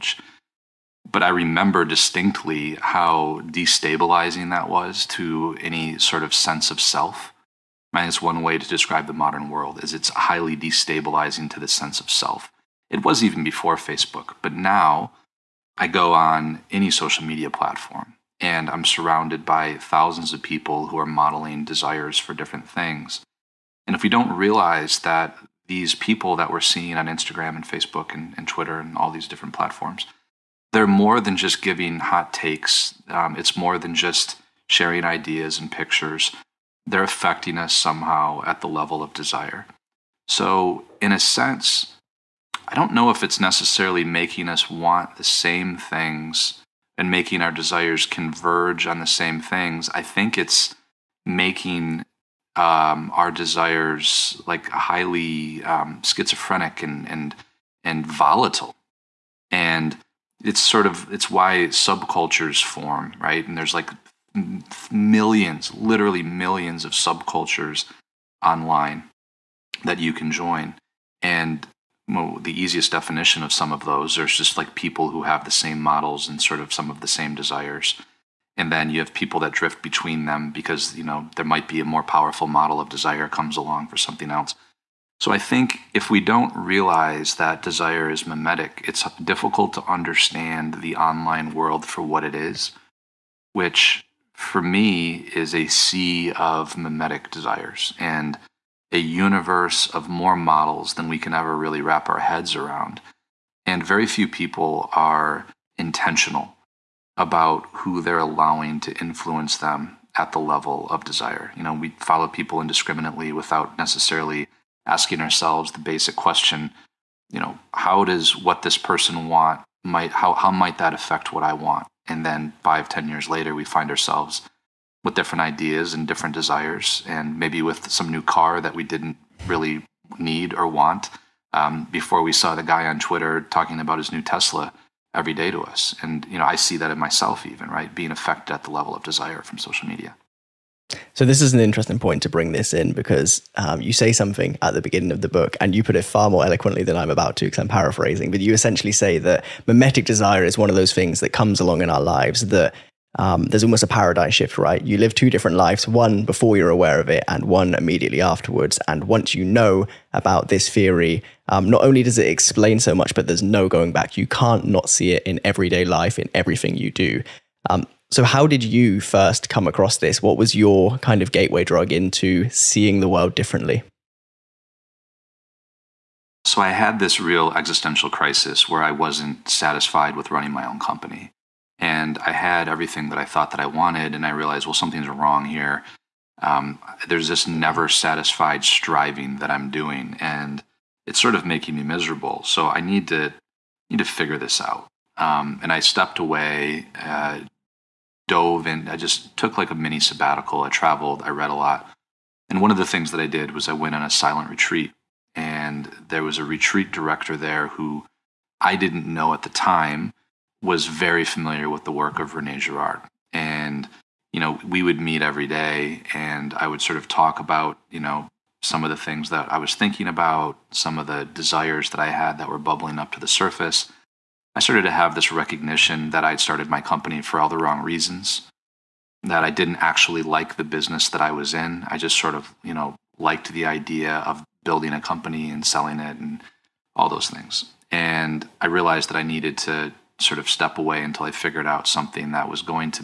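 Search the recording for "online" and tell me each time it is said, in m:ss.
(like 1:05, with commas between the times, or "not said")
1:08, 1:30.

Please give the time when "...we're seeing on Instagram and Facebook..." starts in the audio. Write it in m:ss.
0:26.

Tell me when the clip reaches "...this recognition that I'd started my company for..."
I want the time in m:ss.
3:45.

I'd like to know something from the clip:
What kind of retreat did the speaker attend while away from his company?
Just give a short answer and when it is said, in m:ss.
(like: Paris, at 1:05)
silent retreat, at 3:24.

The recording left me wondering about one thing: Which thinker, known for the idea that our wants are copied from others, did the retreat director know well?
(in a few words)
Rene Girard.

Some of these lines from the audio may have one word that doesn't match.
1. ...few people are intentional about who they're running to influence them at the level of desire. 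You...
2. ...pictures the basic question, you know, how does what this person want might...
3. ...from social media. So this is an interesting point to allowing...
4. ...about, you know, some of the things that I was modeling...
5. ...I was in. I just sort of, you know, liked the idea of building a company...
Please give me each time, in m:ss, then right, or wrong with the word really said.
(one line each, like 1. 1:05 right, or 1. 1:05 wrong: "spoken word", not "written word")
1. 1:44 wrong: "allowing", not "running"
2. 1:55 wrong: "ourselves", not "pictures"
3. 2:19 wrong: "bring", not "allowing"
4. 3:37 wrong: "thinking", not "modeling"
5. 3:51 right.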